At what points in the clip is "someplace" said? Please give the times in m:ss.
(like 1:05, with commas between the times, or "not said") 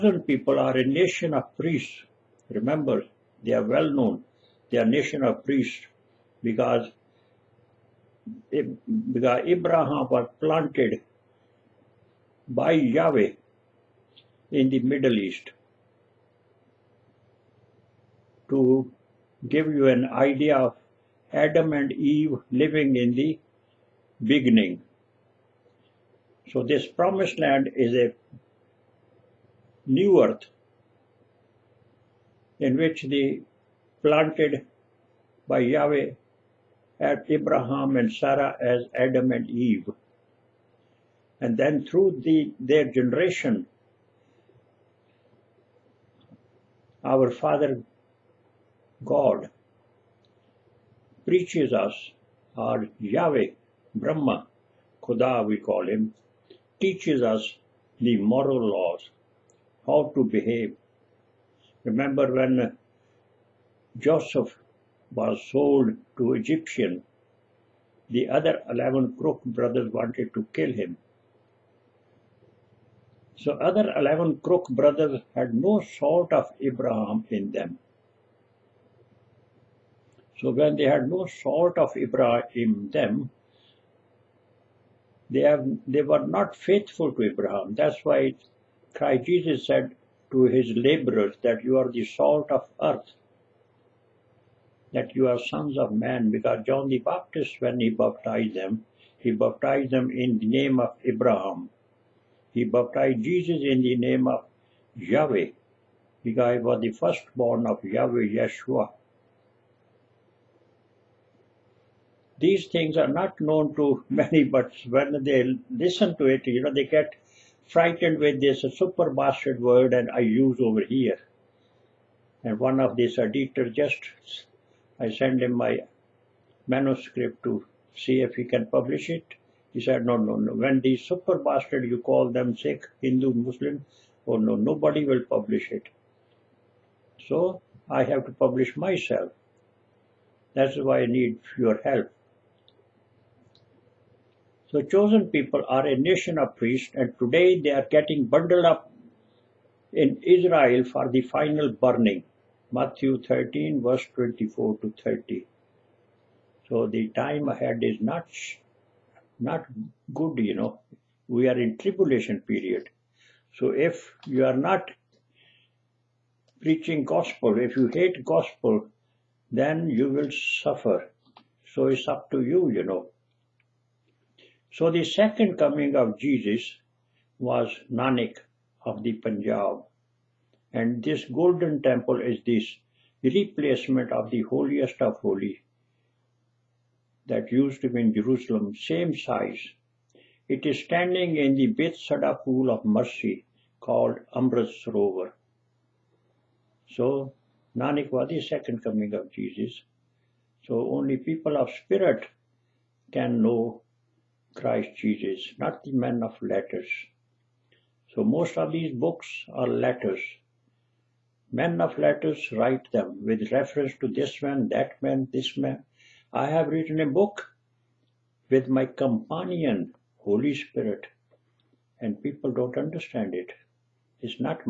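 not said.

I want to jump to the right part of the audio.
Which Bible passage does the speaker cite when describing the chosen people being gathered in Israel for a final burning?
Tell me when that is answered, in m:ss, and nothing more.
2:32.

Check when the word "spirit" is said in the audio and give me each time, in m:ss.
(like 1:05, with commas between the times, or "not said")
3:21, 3:40.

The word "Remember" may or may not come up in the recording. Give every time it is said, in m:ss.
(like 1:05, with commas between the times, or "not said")
0:02, 1:01.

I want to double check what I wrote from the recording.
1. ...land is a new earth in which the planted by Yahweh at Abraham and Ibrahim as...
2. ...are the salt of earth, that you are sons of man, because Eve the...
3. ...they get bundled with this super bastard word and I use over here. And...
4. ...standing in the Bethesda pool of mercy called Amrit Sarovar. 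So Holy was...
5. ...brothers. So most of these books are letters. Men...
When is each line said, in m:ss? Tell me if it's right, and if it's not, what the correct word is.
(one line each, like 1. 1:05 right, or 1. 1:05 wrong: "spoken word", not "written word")
1. 0:27 wrong: "Sarah", not "Ibrahim"
2. 1:31 wrong: "John", not "Eve"
3. 1:56 wrong: "frightened", not "bundled"
4. 3:10 wrong: "Nanak", not "Holy"
5. 3:26 wrong: "letters", not "brothers".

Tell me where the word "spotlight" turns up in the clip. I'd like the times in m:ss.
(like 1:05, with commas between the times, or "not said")
not said.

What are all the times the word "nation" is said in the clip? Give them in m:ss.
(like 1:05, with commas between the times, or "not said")
0:00, 0:04, 2:25.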